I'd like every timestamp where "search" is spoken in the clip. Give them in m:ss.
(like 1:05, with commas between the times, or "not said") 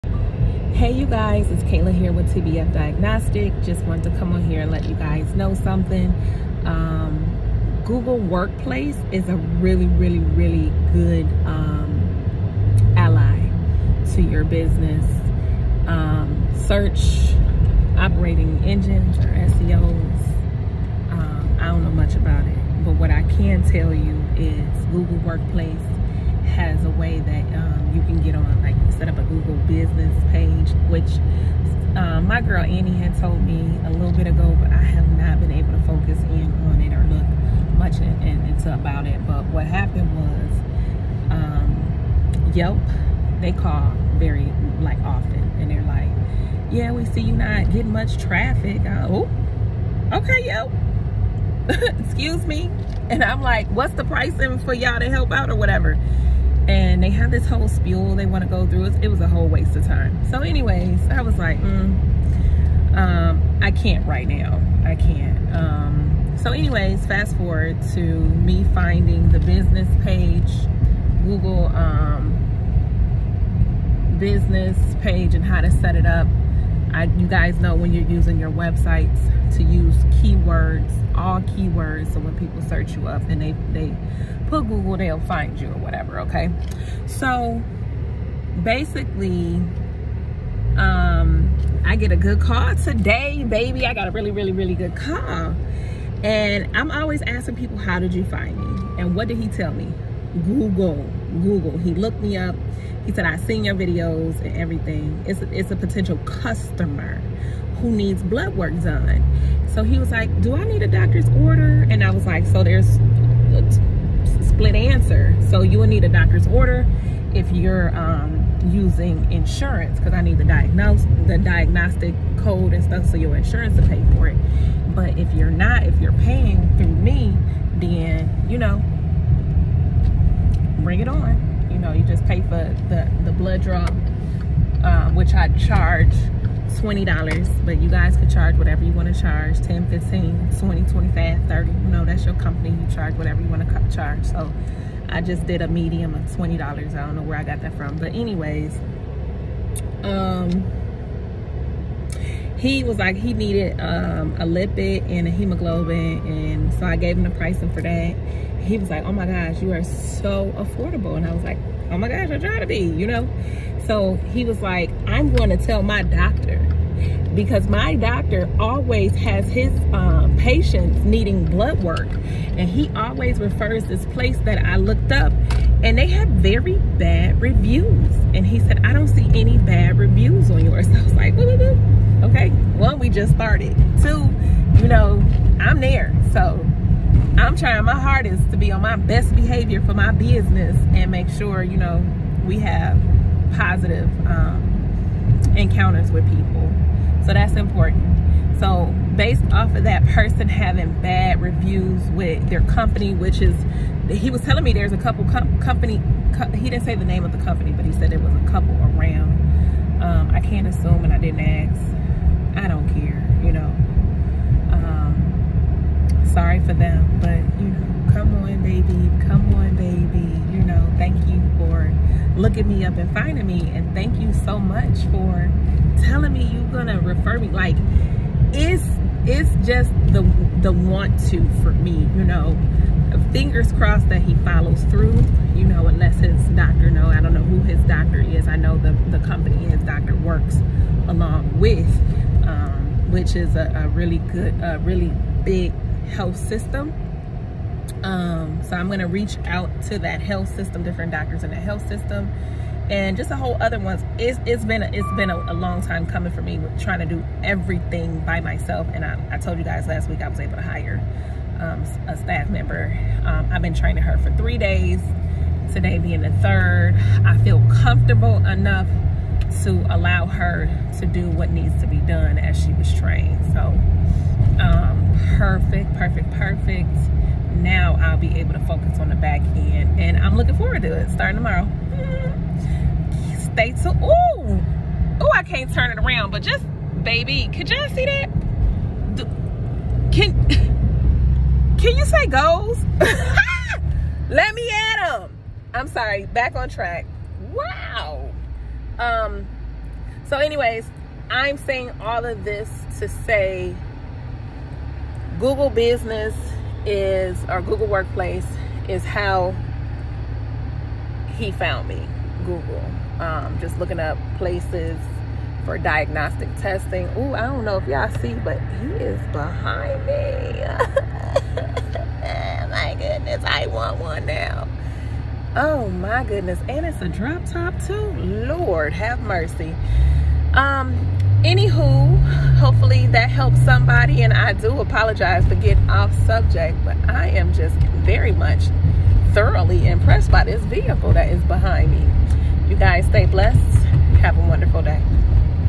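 0:16, 1:22.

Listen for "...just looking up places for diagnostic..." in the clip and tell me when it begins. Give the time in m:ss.
5:13.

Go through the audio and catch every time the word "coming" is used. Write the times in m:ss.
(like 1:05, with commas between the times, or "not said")
4:16.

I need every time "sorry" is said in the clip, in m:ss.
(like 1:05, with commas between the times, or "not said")
3:36, 4:55.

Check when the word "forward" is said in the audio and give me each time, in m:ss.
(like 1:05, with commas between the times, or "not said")
1:07, 4:40.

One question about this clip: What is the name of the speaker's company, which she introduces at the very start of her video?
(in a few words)
TBF Diagnostic.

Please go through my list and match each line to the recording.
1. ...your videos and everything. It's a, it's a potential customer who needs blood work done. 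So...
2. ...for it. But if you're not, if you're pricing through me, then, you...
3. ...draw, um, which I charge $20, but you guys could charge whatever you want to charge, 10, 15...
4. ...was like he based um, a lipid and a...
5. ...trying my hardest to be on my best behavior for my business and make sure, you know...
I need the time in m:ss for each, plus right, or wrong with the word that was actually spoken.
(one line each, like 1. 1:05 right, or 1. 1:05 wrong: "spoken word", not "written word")
1. 1:43 right
2. 2:04 wrong: "paying", not "pricing"
3. 2:13 right
4. 2:32 wrong: "needed", not "based"
5. 3:07 right.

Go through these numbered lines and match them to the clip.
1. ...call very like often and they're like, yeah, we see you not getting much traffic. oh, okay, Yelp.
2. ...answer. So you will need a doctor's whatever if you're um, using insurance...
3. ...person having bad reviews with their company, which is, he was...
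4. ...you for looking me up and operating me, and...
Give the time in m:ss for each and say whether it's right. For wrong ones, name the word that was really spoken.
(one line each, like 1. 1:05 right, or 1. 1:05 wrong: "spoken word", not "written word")
1. 0:43 right
2. 1:54 wrong: "order", not "whatever"
3. 3:20 right
4. 3:41 wrong: "finding", not "operating".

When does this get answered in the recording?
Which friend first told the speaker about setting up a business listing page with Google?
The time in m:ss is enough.
0:32.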